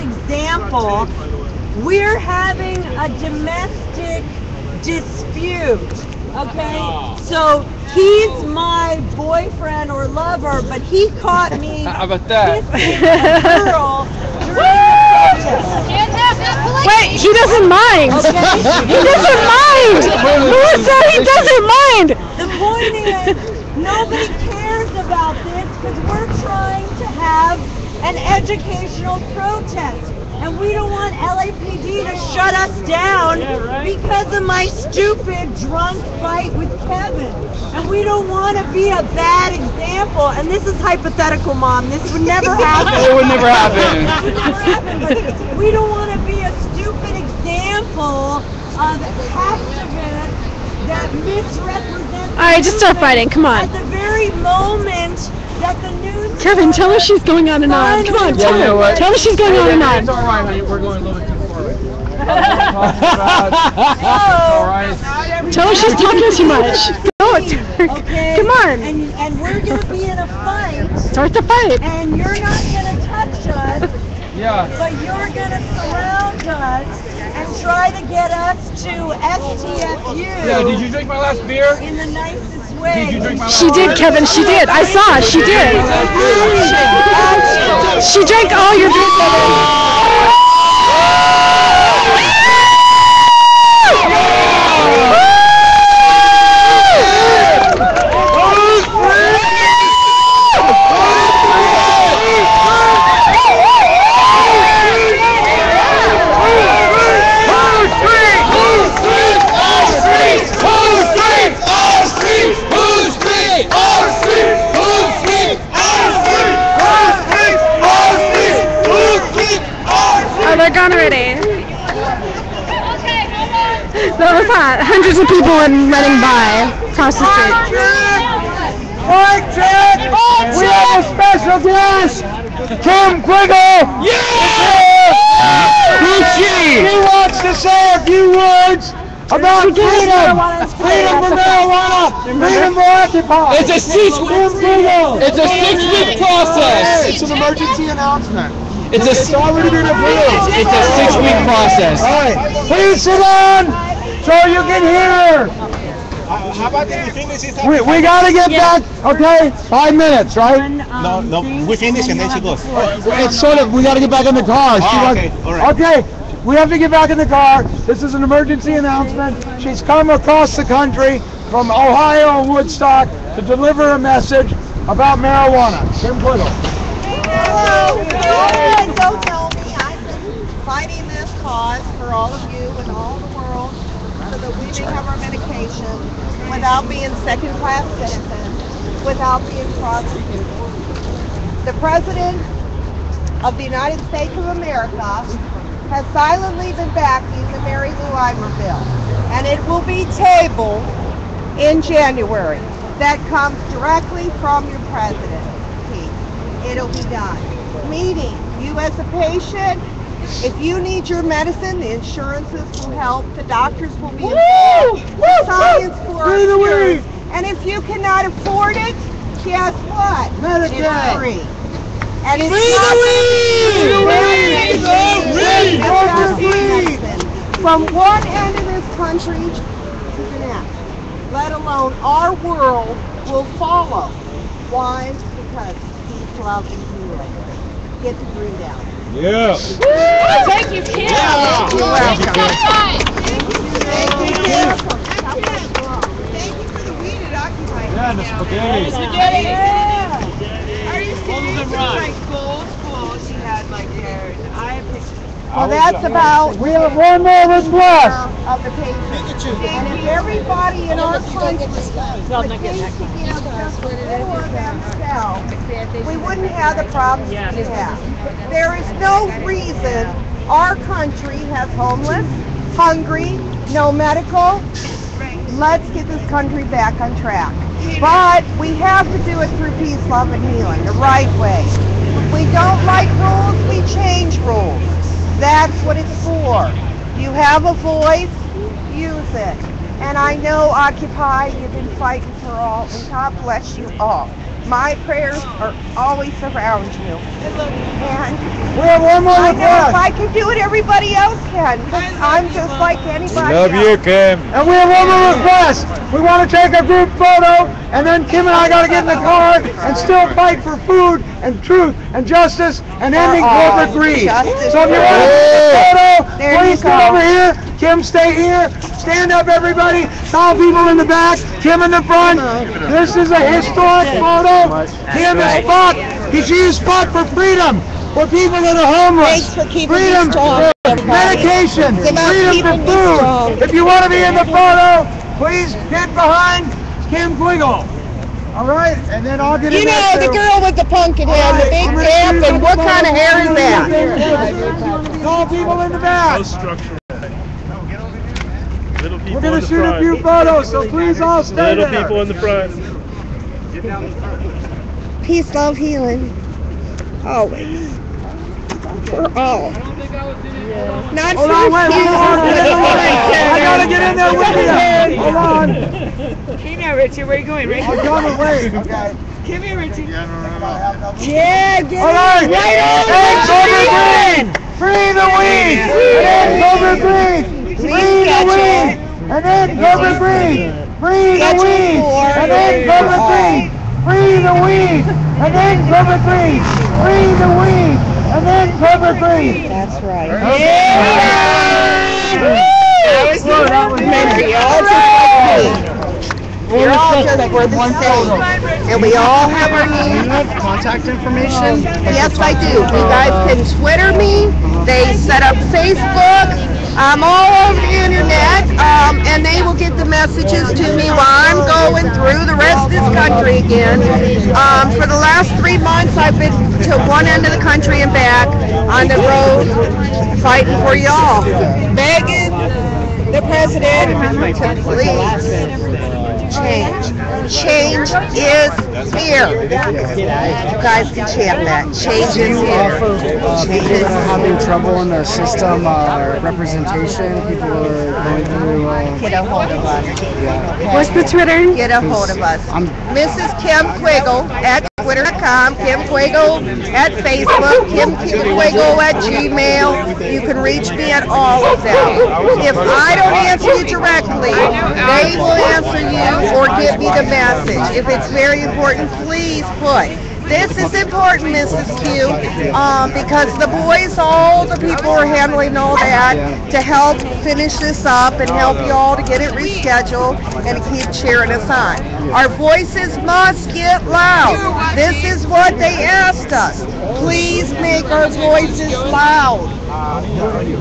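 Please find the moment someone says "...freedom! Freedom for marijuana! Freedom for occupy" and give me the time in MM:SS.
02:19.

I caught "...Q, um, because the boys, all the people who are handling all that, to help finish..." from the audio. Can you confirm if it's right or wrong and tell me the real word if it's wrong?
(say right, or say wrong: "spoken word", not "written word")
right.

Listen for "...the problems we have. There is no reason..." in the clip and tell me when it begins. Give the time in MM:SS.
04:26.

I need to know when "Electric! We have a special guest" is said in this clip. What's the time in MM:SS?
02:10.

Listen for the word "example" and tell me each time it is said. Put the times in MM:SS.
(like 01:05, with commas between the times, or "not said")
00:00, 00:39, 00:47.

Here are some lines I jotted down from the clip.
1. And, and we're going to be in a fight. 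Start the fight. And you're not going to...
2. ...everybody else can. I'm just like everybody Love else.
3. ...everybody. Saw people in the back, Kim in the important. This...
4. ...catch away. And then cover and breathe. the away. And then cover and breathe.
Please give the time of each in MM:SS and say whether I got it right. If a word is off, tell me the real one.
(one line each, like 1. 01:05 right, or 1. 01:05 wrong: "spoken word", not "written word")
1. 01:08 right
2. 05:00 wrong: "anybody", not "everybody"
3. 05:19 wrong: "front", not "important"
4. 06:21 right.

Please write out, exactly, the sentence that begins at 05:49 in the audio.
Little people We're going to shoot front.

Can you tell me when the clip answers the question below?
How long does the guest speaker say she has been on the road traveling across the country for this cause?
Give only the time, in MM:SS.
06:55.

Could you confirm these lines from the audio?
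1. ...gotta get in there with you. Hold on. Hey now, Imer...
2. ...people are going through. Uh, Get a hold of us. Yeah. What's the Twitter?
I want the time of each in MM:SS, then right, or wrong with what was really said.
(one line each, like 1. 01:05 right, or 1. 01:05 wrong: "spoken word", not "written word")
1. 06:03 wrong: "Richard", not "Imer"
2. 07:17 right.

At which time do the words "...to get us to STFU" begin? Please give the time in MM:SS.
01:17.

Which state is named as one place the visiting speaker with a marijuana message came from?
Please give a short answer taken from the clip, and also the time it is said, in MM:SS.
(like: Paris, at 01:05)
Ohio, at 02:51.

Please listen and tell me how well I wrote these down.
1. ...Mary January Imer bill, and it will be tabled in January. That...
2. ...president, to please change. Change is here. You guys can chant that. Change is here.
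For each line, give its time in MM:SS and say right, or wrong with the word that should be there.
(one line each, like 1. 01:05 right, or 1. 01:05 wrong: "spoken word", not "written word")
1. 03:17 wrong: "Lou", not "January"
2. 07:03 right.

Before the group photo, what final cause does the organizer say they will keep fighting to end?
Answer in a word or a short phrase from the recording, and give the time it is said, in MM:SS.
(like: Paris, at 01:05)
corporate greed, at 05:13.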